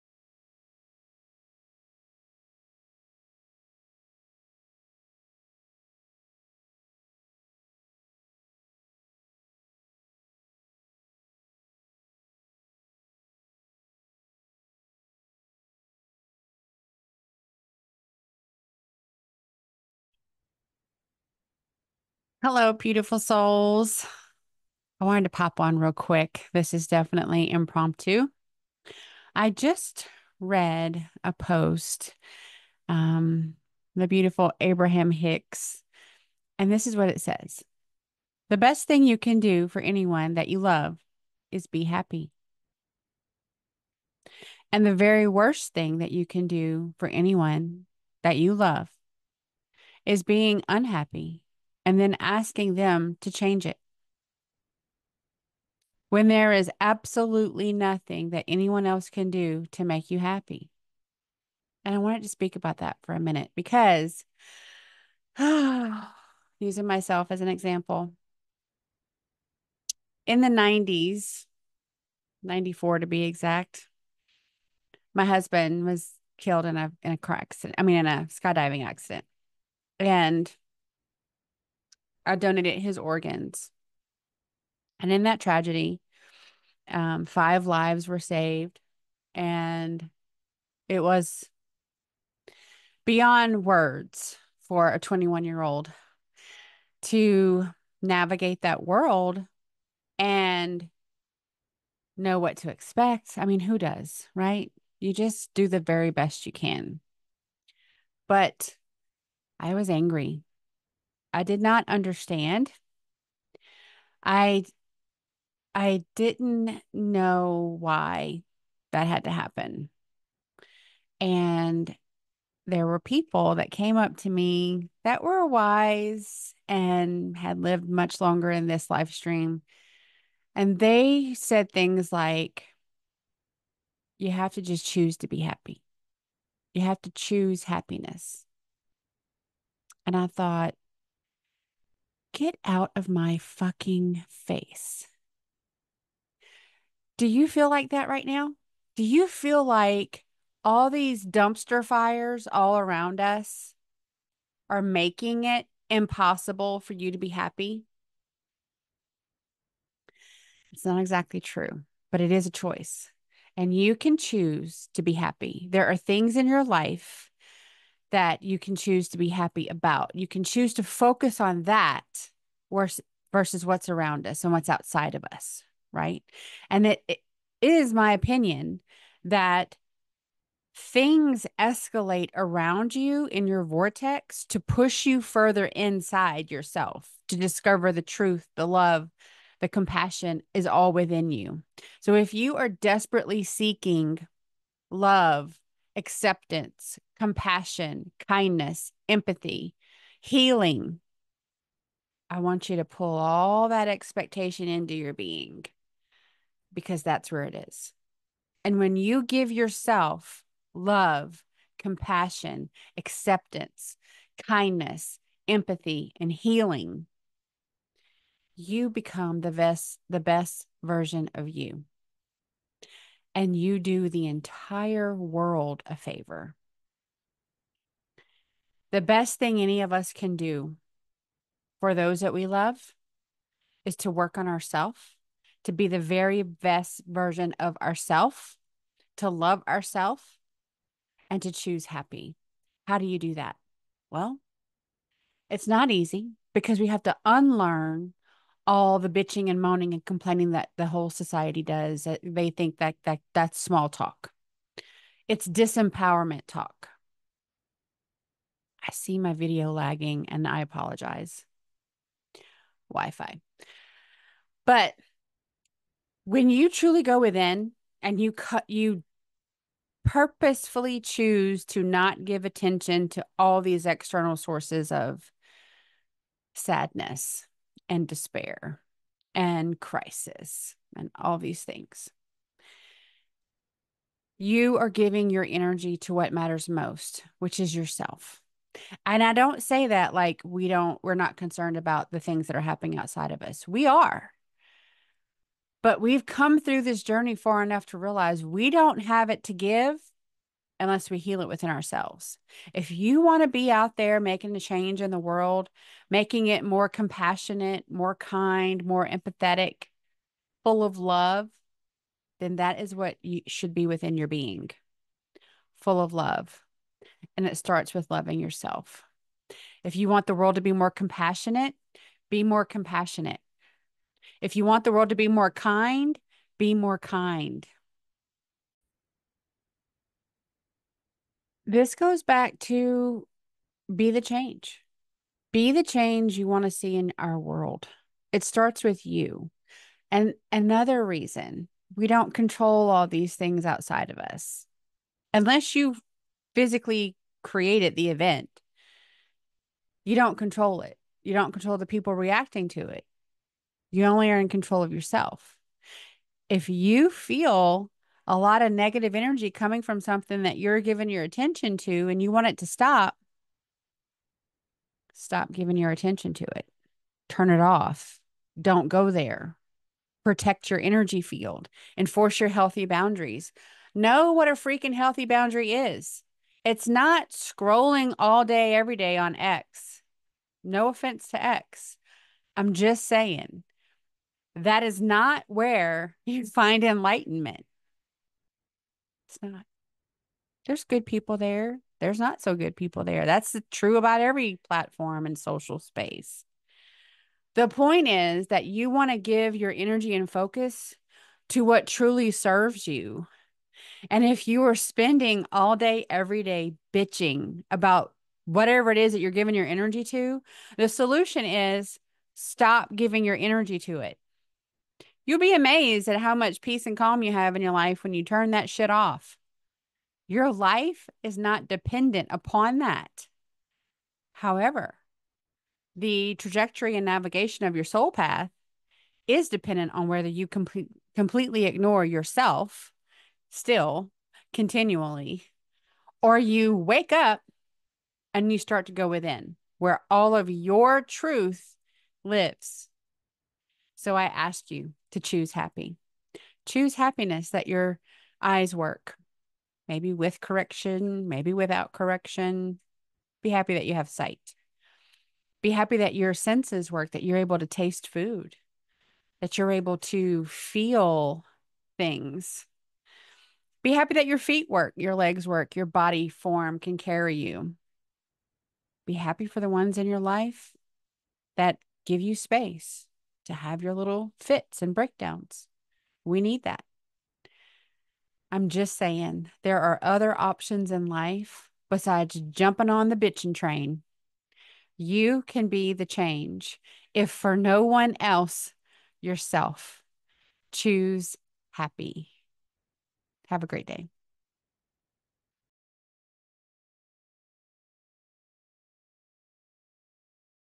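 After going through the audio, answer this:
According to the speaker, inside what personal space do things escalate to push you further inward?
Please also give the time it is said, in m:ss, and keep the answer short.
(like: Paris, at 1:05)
Your vortex, at 3:03.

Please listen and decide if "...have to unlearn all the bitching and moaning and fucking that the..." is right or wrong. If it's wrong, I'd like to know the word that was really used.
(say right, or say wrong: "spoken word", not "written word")
wrong: "complaining", not "fucking".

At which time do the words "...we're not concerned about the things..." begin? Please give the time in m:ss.
4:51.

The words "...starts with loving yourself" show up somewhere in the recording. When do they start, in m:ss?
5:17.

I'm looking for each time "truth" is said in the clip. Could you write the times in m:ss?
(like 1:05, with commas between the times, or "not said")
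3:08, 7:21.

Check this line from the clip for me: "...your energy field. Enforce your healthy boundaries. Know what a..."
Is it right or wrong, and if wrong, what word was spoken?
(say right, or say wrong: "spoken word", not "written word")
right.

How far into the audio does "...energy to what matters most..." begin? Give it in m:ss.
4:45.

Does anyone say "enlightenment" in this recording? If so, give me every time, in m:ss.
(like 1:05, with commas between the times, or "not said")
6:26.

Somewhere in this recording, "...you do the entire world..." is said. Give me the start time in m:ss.
3:43.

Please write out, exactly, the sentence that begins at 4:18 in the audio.
I see my video lagging and I apologize.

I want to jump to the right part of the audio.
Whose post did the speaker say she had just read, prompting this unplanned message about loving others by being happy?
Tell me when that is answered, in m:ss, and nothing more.
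0:34.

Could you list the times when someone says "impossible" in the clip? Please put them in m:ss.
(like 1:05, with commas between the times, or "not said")
2:35.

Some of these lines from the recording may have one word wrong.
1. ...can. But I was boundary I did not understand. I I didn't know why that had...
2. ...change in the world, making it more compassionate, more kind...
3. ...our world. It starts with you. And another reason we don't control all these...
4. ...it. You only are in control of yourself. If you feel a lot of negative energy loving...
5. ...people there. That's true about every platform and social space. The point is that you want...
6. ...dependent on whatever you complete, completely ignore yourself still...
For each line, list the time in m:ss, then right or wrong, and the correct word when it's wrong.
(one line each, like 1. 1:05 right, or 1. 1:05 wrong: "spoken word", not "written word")
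1. 1:46 wrong: "angry", not "boundary"
2. 5:04 right
3. 5:37 right
4. 5:52 wrong: "coming", not "loving"
5. 6:32 right
6. 7:09 wrong: "whether", not "whatever".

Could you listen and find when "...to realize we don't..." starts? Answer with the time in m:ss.
4:57.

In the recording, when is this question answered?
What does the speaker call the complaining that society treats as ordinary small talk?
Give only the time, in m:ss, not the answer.
4:15.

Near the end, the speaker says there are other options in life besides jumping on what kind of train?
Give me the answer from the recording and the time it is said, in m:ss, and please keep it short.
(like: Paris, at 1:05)
The bitching train, at 8:03.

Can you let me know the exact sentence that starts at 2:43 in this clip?
And you can choose to be happy.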